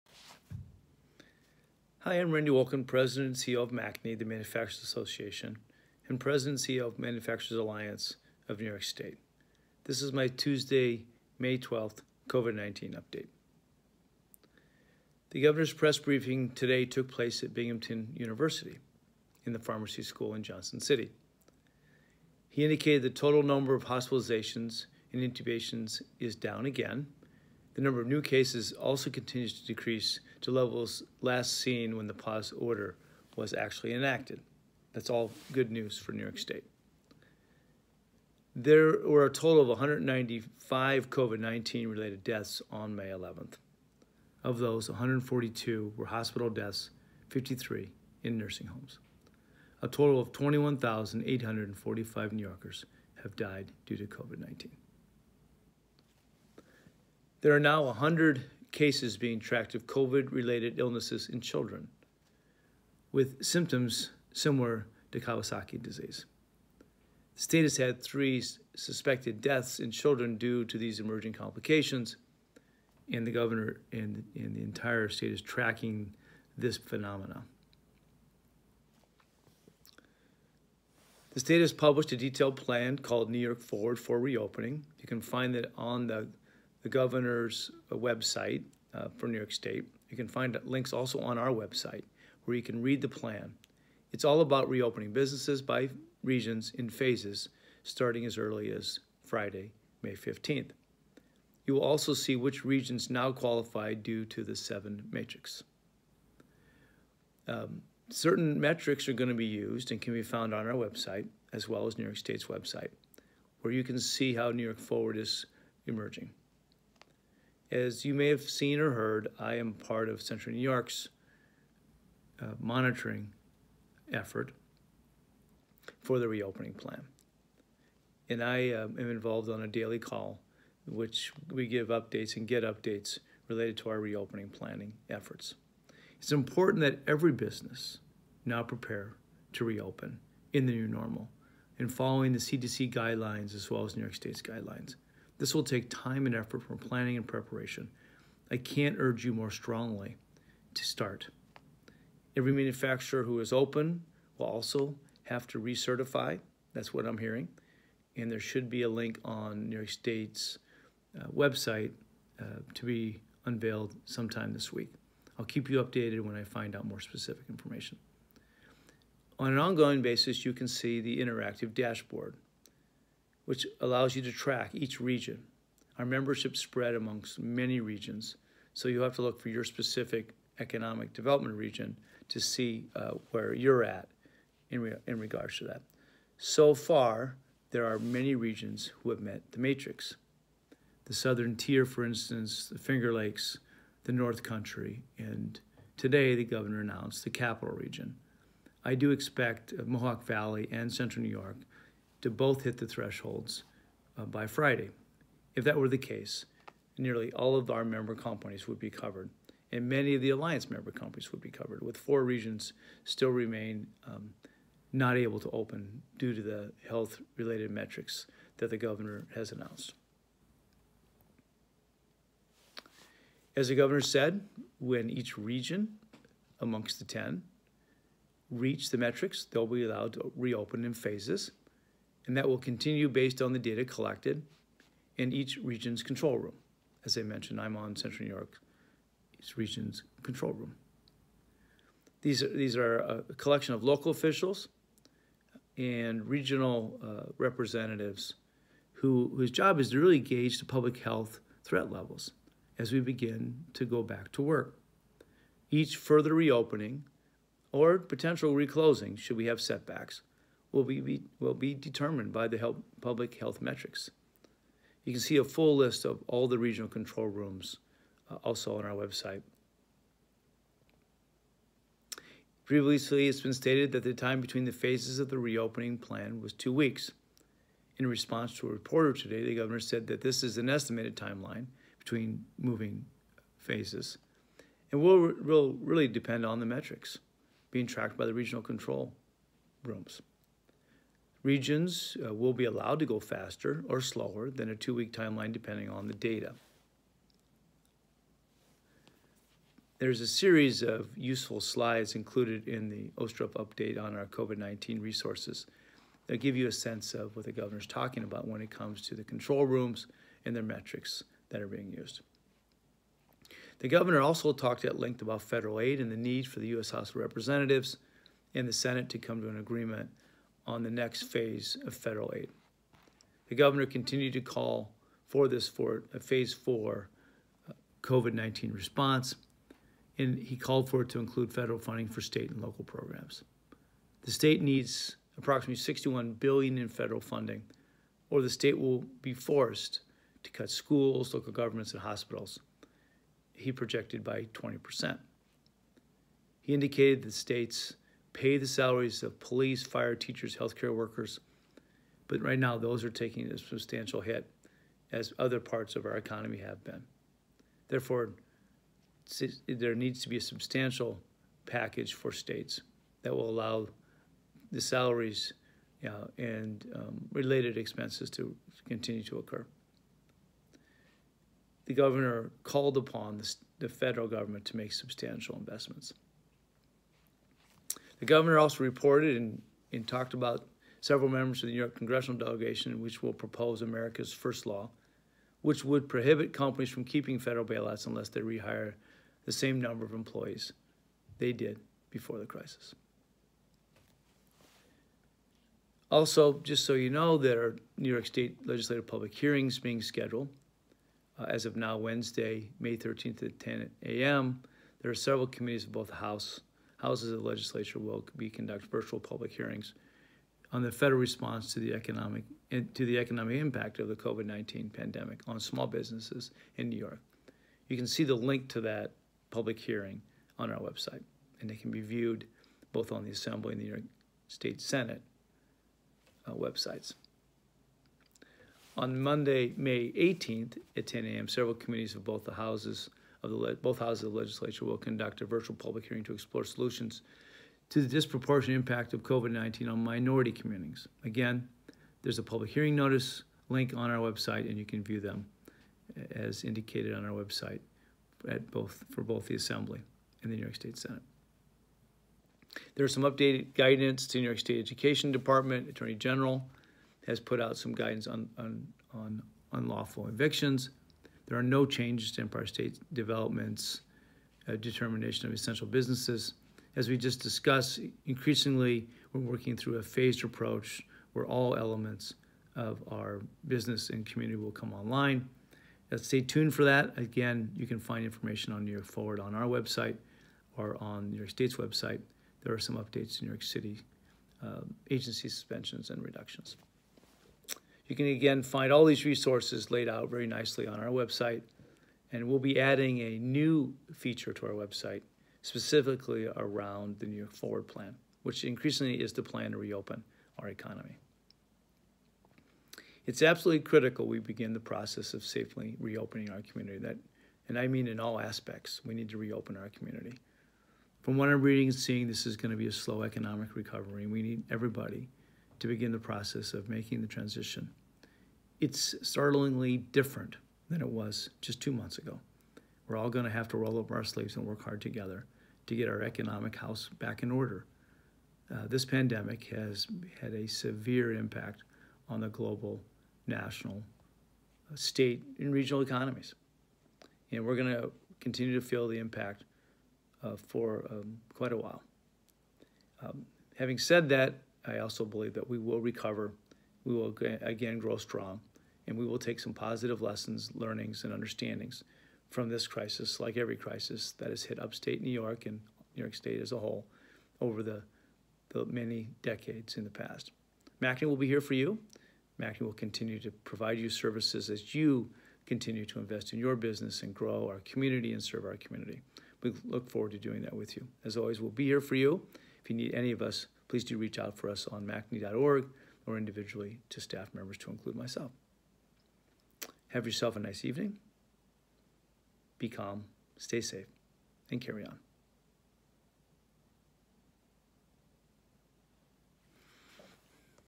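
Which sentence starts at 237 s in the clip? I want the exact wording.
As I mentioned, I'm on Central New York's region's control room.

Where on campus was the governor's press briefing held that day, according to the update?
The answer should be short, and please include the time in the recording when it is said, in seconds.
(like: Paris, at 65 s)
pharmacy school, at 19 s.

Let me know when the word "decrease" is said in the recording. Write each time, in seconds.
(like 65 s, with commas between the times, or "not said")
29 s.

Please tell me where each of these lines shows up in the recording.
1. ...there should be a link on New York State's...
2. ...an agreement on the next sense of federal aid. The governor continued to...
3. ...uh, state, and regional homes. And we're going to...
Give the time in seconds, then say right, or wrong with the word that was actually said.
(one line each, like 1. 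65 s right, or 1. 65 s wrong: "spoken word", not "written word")
1. 158 s right
2. 319 s wrong: "phase", not "sense"
3. 534 s wrong: "economies", not "homes".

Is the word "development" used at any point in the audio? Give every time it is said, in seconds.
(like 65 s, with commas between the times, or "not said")
181 s, 463 s.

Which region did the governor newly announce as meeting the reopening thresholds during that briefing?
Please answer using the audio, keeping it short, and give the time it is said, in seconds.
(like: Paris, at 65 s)
capital region, at 197 s.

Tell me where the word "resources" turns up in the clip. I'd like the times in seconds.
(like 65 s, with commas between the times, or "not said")
305 s, 489 s.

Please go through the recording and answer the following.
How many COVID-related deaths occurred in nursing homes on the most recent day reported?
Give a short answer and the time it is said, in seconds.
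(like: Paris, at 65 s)
53, at 47 s.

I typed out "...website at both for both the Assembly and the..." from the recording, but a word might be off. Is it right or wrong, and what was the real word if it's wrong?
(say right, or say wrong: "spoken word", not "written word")
right.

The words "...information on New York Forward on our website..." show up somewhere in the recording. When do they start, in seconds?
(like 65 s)
478 s.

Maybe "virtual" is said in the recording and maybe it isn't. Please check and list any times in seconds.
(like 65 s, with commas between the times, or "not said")
408 s, 435 s.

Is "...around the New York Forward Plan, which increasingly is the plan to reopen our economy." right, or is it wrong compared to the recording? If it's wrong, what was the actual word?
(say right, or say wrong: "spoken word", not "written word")
right.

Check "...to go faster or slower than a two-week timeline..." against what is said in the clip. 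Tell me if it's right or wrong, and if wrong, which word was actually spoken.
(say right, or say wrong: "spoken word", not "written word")
right.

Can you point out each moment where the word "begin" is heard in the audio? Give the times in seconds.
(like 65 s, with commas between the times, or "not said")
252 s, 504 s, 515 s.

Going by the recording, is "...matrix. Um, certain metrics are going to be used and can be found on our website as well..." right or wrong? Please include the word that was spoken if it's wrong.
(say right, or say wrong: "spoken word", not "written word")
right.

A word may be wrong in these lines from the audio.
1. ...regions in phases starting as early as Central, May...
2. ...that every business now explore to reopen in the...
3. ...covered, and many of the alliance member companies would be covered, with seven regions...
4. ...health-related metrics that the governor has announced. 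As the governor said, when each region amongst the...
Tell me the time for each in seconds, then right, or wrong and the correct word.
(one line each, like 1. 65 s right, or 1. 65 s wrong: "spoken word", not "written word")
1. 96 s wrong: "Friday", not "Central"
2. 136 s wrong: "prepare", not "explore"
3. 208 s wrong: "four", not "seven"
4. 216 s right.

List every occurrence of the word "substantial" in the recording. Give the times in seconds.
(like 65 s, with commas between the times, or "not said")
353 s, 360 s, 374 s.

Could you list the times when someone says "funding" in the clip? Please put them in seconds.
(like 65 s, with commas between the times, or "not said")
331 s, 337 s.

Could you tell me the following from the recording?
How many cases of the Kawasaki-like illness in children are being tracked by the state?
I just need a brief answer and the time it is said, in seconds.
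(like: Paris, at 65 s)
100, at 57 s.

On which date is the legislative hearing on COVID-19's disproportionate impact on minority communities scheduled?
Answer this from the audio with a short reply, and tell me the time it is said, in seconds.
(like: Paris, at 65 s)
May 18th, at 429 s.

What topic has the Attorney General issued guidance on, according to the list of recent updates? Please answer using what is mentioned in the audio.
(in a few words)
unlawful evictions.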